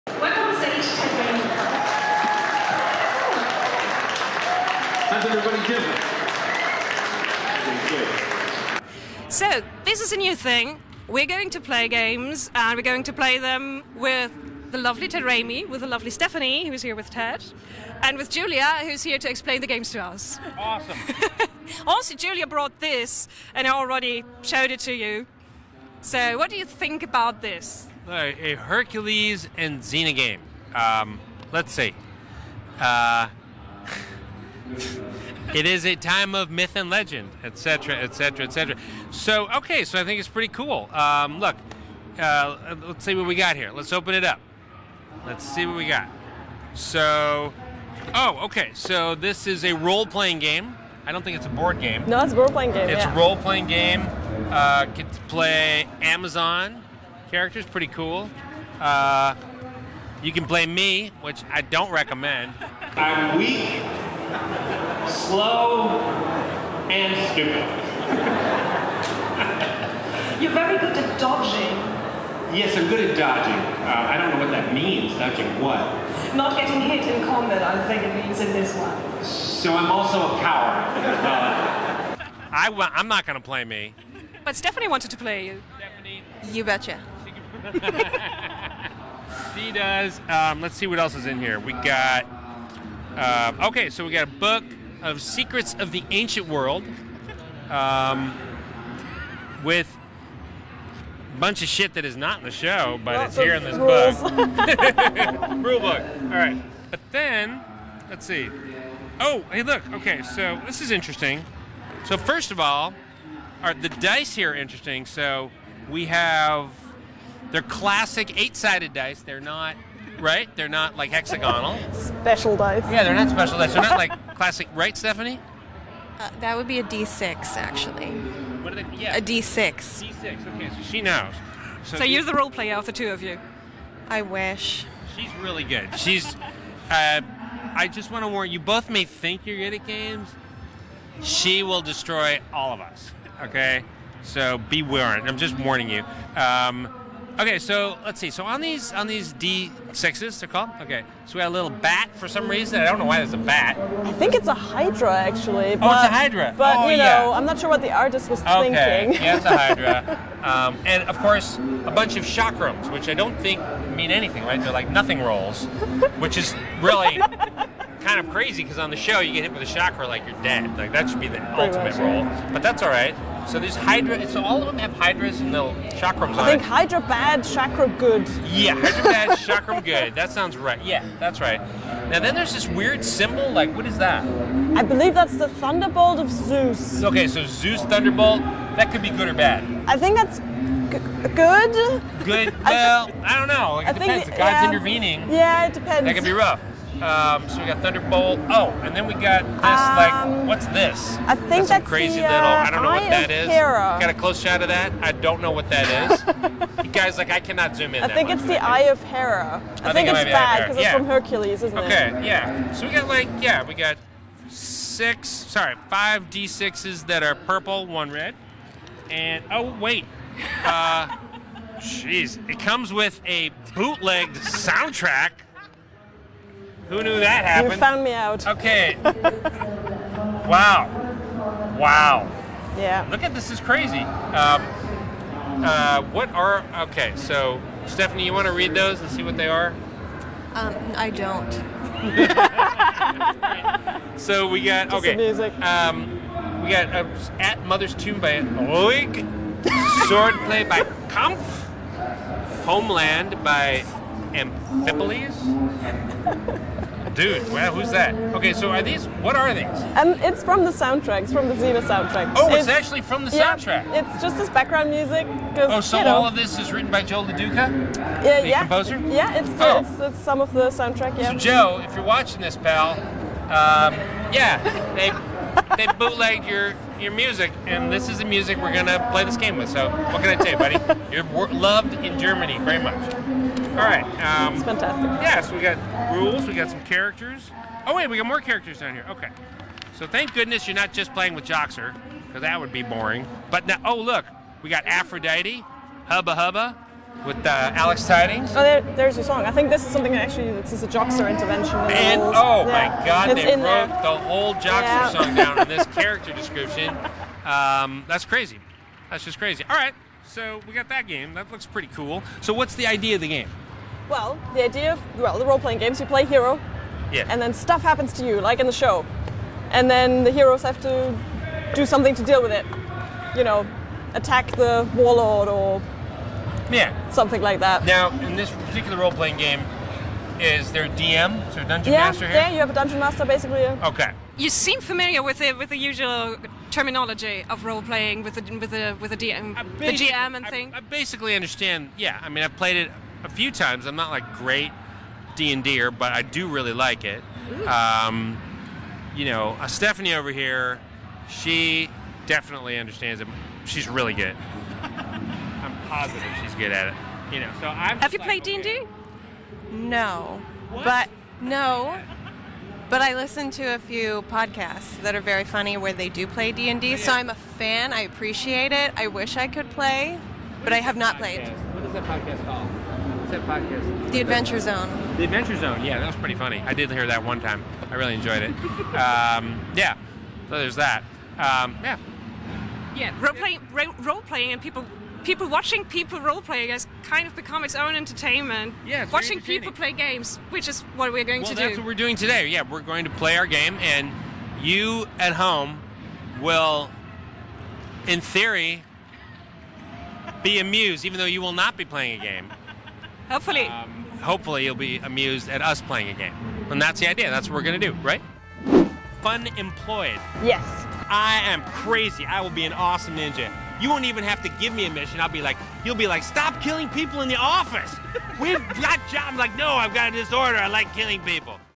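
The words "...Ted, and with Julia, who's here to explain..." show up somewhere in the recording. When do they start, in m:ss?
0:17.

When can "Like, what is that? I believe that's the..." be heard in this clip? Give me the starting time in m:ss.
3:03.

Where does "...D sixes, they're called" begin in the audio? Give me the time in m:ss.
2:29.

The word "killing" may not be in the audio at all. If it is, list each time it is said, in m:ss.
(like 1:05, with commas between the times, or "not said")
6:56, 7:00.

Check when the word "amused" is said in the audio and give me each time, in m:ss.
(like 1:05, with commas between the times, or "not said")
6:40, 6:44.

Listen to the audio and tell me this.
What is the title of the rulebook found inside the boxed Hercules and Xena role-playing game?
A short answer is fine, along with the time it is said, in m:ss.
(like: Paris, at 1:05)
Secrets of the Ancient World, at 1:35.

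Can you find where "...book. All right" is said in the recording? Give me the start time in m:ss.
1:45.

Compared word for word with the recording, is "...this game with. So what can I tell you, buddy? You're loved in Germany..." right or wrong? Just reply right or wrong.
right.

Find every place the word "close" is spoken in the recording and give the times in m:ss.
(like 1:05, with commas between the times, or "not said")
3:24.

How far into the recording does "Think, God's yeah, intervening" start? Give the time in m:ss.
3:14.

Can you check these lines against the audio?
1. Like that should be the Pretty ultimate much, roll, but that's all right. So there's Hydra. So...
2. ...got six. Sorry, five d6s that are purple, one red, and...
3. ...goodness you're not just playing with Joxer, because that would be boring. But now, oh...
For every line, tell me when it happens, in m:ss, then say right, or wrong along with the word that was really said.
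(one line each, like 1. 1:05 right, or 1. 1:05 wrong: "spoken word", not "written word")
1. 2:50 right
2. 3:33 right
3. 4:50 right.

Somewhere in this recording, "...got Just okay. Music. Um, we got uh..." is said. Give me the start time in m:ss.
4:04.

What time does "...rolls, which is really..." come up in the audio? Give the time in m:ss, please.
2:45.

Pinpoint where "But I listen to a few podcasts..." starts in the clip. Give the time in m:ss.
6:02.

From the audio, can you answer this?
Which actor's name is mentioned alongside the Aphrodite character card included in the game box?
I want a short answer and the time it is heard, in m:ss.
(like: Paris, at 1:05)
Alex Tydings, at 4:57.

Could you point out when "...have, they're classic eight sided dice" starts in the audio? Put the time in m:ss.
1:56.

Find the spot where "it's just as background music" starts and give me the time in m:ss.
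4:24.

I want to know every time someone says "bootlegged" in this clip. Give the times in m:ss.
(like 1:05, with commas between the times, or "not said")
3:43, 4:35.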